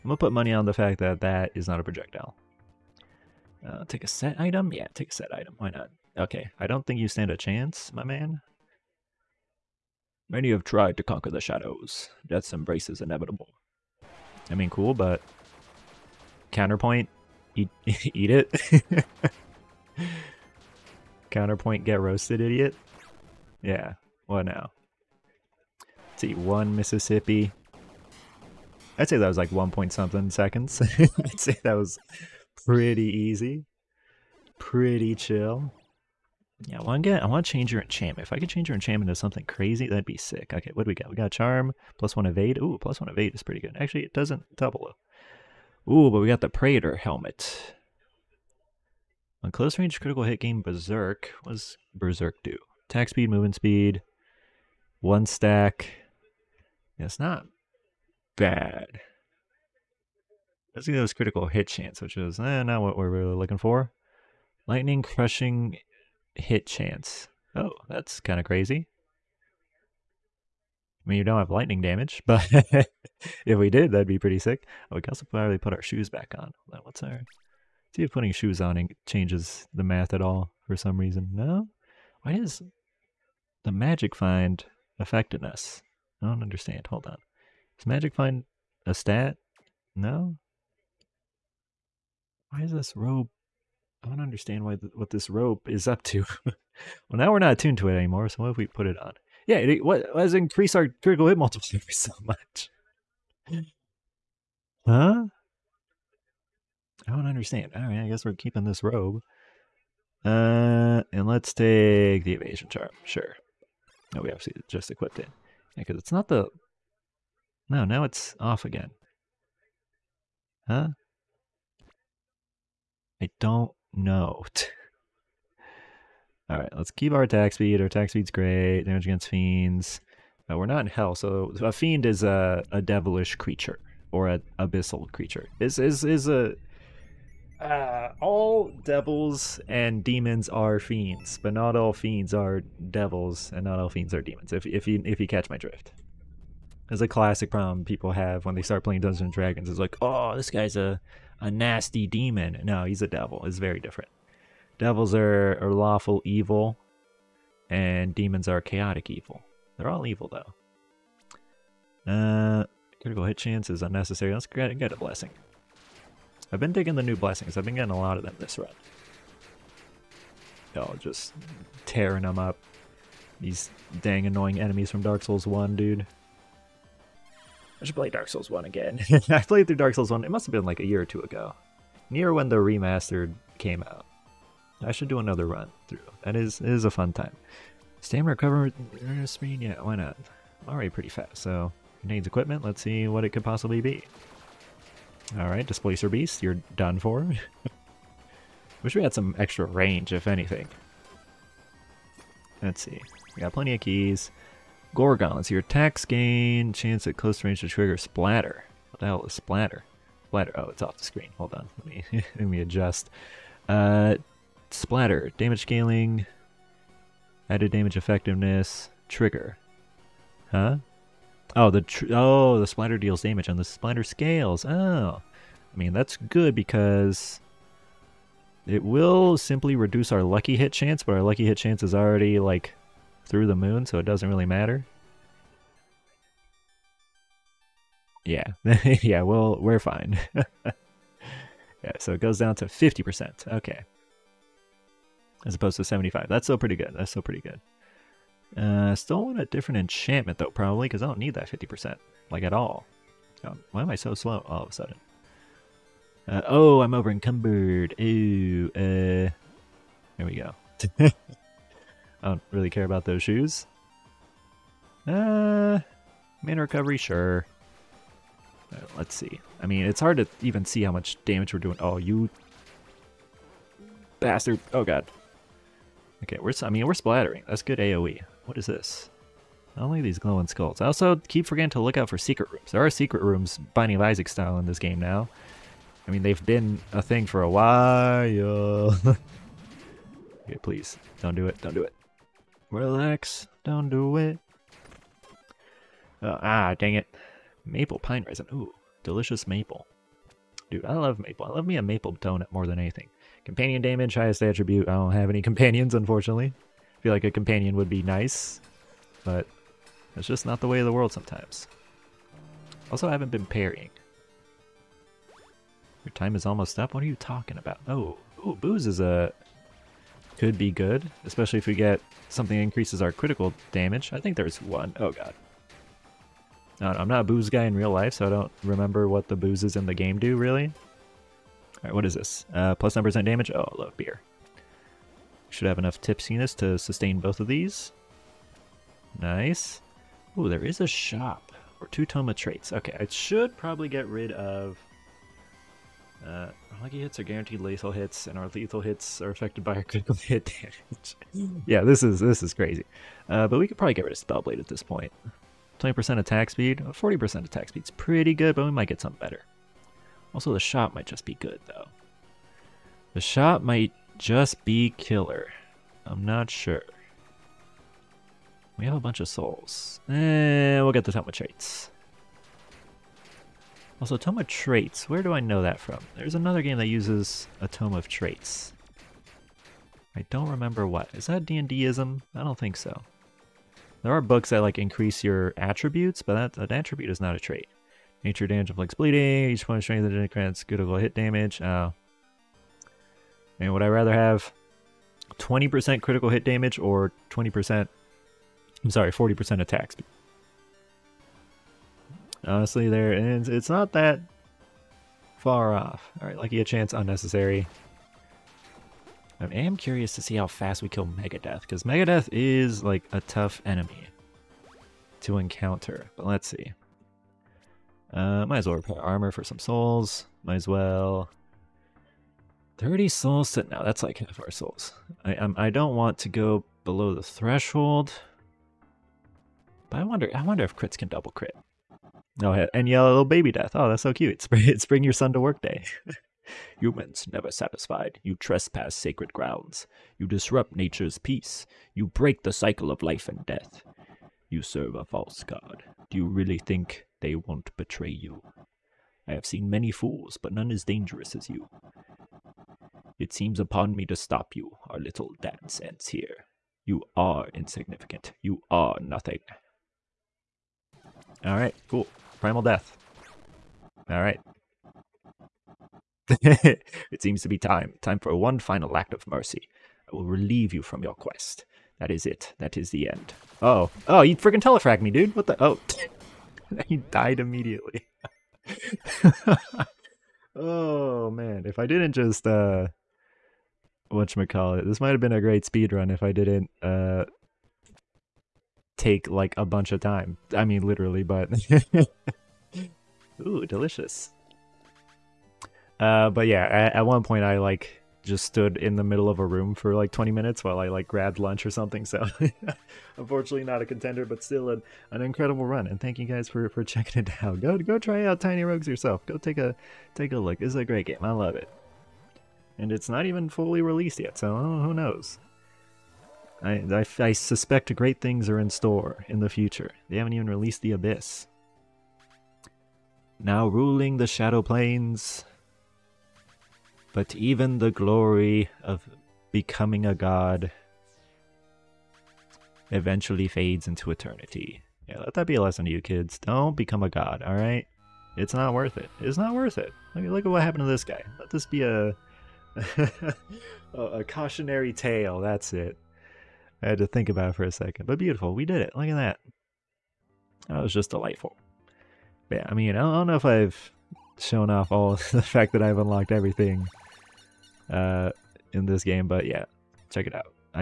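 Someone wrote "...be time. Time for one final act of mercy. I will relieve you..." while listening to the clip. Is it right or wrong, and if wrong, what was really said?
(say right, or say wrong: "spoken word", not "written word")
right.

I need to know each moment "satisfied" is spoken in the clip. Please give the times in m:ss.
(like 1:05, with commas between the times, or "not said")
7:17.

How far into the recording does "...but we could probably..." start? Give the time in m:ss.
5:53.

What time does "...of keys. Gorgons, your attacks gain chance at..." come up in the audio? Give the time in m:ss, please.
3:23.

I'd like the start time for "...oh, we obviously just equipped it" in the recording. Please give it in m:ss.
1:54.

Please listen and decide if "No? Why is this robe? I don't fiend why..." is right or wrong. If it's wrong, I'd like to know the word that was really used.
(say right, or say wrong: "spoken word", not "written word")
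wrong: "understand", not "fiend".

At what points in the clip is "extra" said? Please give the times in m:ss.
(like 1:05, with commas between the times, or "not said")
3:19.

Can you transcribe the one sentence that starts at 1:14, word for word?
Oh, we can also probably put our shoes back on.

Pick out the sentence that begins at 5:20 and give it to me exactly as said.
Could be good, especially if we get something that increases our critical damage.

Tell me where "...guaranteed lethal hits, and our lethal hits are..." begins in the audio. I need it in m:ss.
5:47.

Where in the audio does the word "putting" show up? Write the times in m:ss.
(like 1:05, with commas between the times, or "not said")
1:18.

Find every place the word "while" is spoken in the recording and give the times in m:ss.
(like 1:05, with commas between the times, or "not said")
4:47, 8:20.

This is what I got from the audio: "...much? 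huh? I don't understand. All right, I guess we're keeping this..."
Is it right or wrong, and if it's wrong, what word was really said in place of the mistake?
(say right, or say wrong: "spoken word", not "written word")
right.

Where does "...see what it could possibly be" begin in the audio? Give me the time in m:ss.
3:12.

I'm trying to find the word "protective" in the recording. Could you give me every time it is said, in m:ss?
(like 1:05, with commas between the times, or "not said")
not said.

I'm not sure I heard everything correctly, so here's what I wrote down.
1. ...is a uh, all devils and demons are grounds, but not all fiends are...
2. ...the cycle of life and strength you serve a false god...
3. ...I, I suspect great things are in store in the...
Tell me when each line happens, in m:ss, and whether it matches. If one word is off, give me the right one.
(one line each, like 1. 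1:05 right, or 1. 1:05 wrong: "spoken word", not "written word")
1. 2:16 wrong: "fiends", not "grounds"
2. 7:22 wrong: "death", not "strength"
3. 8:36 right.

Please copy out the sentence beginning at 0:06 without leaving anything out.
Okay, I don't think you stand a chance, my man.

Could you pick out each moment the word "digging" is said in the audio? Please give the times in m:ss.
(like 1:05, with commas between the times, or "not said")
2:46.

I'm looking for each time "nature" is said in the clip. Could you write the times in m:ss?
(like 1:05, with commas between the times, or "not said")
6:28, 7:20.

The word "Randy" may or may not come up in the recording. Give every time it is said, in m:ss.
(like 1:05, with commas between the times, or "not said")
not said.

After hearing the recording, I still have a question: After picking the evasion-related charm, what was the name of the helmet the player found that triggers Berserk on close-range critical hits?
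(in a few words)
Praetor helmet.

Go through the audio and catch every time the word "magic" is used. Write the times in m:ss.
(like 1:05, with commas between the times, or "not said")
1:23, 1:27.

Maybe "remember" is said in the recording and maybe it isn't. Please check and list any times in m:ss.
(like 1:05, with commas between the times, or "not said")
5:28, 6:20.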